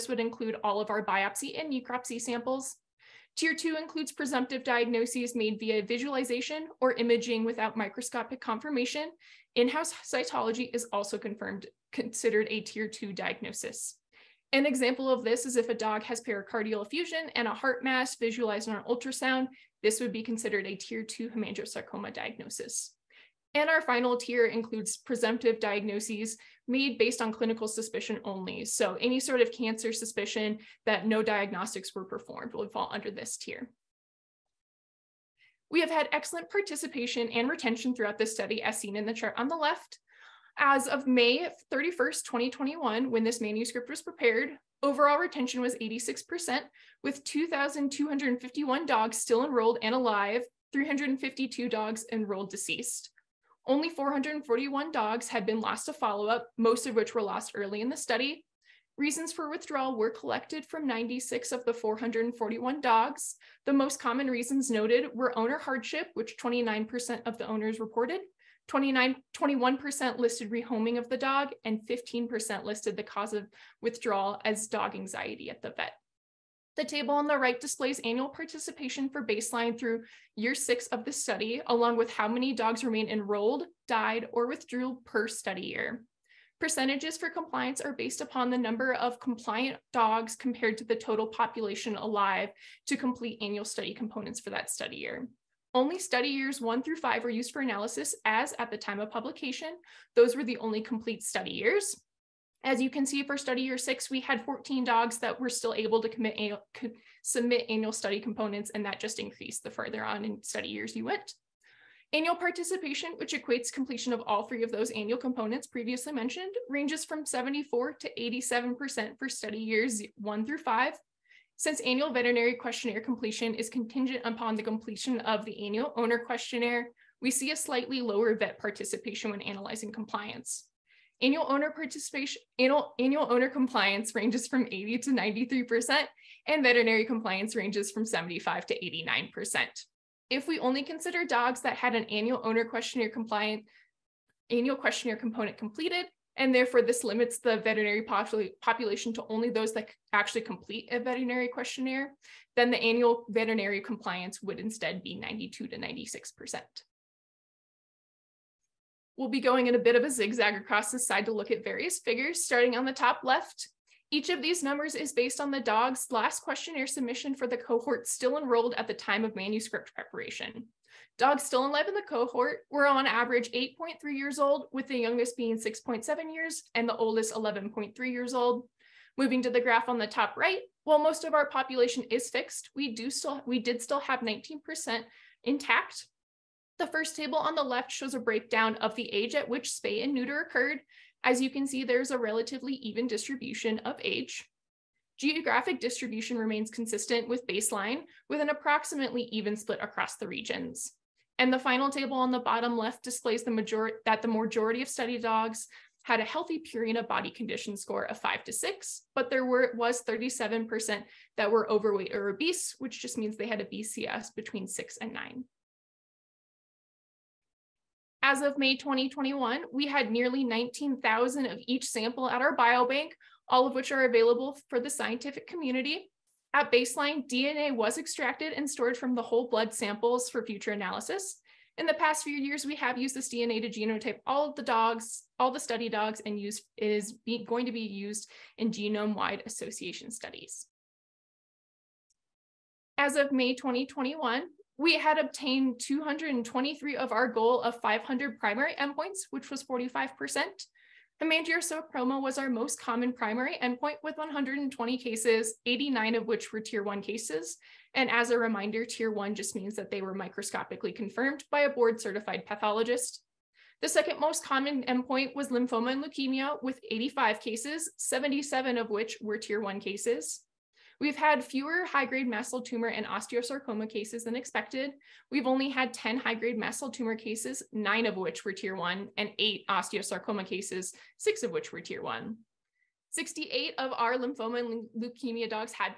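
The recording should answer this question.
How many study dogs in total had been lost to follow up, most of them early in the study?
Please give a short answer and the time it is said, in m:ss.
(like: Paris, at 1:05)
441, at 0:53.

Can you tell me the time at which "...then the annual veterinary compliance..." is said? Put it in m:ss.
2:32.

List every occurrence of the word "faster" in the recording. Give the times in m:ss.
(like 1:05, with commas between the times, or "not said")
not said.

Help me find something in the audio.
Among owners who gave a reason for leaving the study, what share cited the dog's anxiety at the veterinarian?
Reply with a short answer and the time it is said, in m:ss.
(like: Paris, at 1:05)
15%, at 1:11.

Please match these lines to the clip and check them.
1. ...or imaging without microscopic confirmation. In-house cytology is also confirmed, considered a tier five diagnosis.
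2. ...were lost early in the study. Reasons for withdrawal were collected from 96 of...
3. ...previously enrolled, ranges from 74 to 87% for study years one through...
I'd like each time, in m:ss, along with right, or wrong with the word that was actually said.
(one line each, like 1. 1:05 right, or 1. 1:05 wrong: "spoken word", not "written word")
1. 0:06 wrong: "two", not "five"
2. 0:57 right
3. 1:55 wrong: "mentioned", not "enrolled".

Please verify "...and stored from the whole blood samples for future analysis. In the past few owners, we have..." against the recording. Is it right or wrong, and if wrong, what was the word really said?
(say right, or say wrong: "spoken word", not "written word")
wrong: "years", not "owners".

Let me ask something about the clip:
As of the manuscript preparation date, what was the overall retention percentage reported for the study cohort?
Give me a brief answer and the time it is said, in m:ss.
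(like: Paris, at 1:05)
86%, at 0:45.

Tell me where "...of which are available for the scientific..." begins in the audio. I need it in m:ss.
3:43.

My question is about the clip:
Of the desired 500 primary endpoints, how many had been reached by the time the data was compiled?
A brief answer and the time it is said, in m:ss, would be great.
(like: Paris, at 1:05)
223, at 4:05.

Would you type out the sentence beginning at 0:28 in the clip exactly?
So any sort of cancer suspicion that no diagnostics were performed would fall under this tier.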